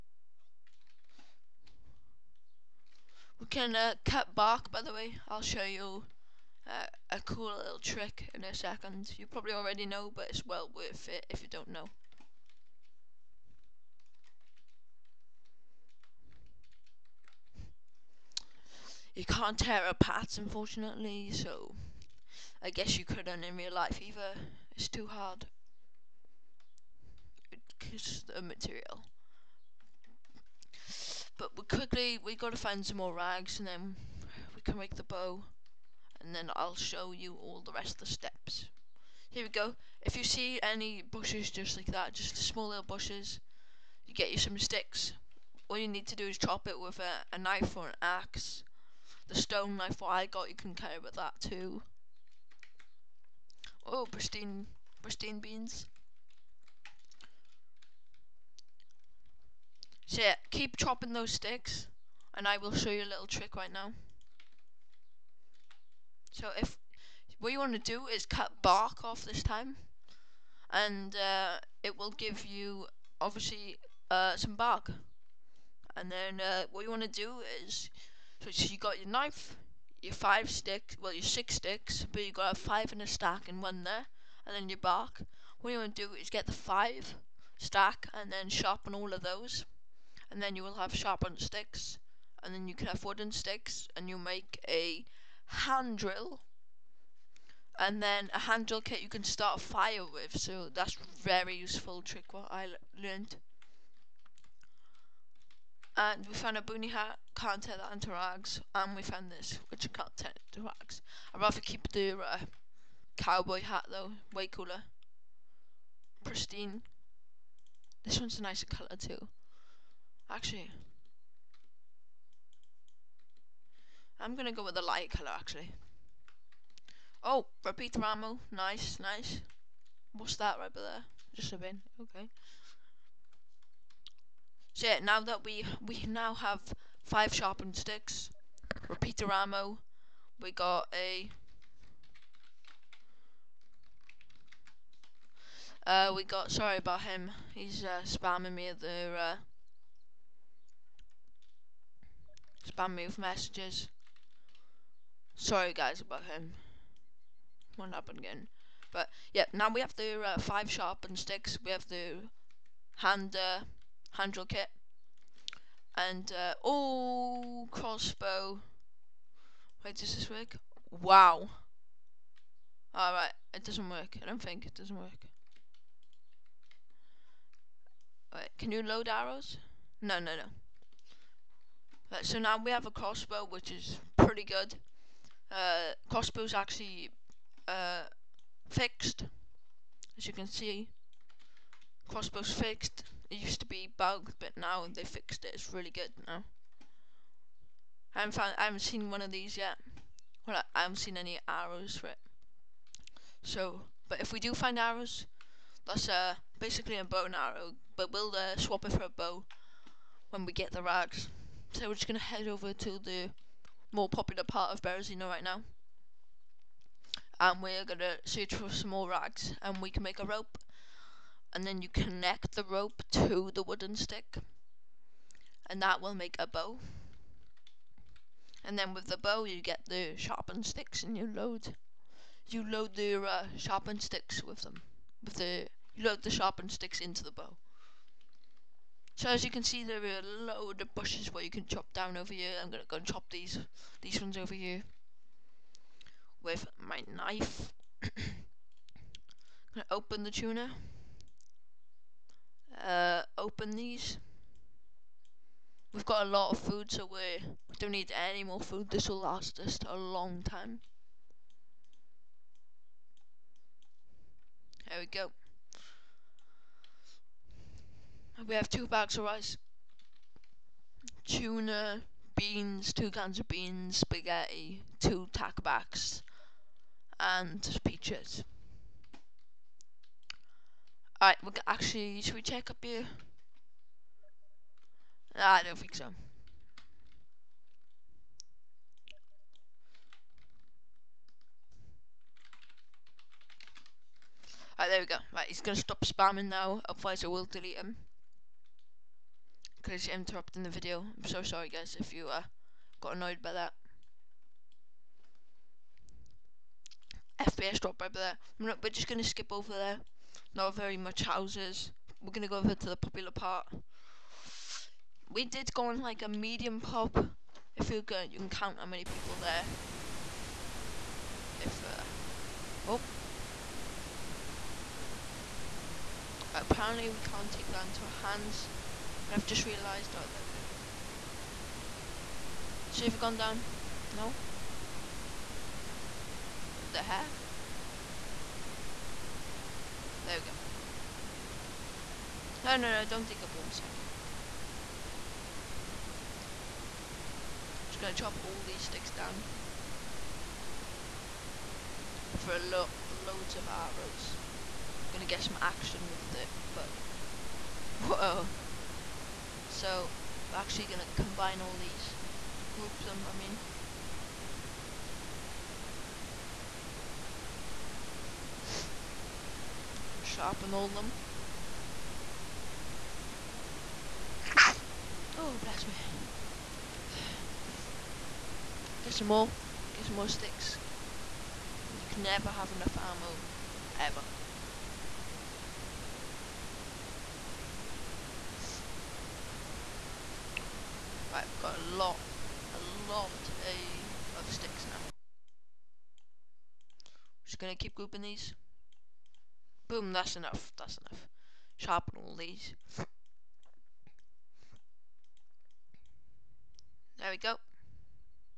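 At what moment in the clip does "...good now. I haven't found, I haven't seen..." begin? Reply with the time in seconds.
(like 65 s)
195 s.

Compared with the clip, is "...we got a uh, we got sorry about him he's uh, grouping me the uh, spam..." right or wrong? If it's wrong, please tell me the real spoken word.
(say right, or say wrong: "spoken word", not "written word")
wrong: "spamming", not "grouping".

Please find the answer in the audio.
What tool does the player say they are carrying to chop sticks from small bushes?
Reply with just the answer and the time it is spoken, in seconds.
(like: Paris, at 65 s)
Stone knife, at 49 s.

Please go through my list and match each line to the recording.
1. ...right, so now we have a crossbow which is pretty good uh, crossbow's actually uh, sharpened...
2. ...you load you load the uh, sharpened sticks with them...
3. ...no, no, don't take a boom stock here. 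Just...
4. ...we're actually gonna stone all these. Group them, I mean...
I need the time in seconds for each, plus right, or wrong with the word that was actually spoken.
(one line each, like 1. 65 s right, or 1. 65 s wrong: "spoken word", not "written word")
1. 182 s wrong: "fixed", not "sharpened"
2. 231 s right
3. 342 s right
4. 360 s wrong: "combine", not "stone".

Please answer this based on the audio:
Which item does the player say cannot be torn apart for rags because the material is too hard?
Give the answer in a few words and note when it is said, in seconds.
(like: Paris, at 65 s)
Pads, at 19 s.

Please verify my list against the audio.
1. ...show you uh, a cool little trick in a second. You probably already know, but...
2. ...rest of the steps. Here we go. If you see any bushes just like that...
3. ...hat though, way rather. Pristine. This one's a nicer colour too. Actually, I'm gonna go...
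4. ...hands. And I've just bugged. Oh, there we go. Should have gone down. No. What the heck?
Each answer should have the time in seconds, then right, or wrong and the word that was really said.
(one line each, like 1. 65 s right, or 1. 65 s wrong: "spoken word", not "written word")
1. 5 s right
2. 37 s right
3. 113 s wrong: "cooler", not "rather"
4. 328 s wrong: "realised", not "bugged".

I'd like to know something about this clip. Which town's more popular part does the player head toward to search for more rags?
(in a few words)
Berezino.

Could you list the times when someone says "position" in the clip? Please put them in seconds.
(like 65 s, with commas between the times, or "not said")
not said.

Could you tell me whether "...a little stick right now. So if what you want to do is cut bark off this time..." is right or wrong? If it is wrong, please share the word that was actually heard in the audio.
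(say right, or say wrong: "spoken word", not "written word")
wrong: "trick", not "stick".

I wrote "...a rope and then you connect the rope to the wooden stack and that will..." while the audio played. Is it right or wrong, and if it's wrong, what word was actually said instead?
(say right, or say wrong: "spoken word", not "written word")
wrong: "stick", not "stack".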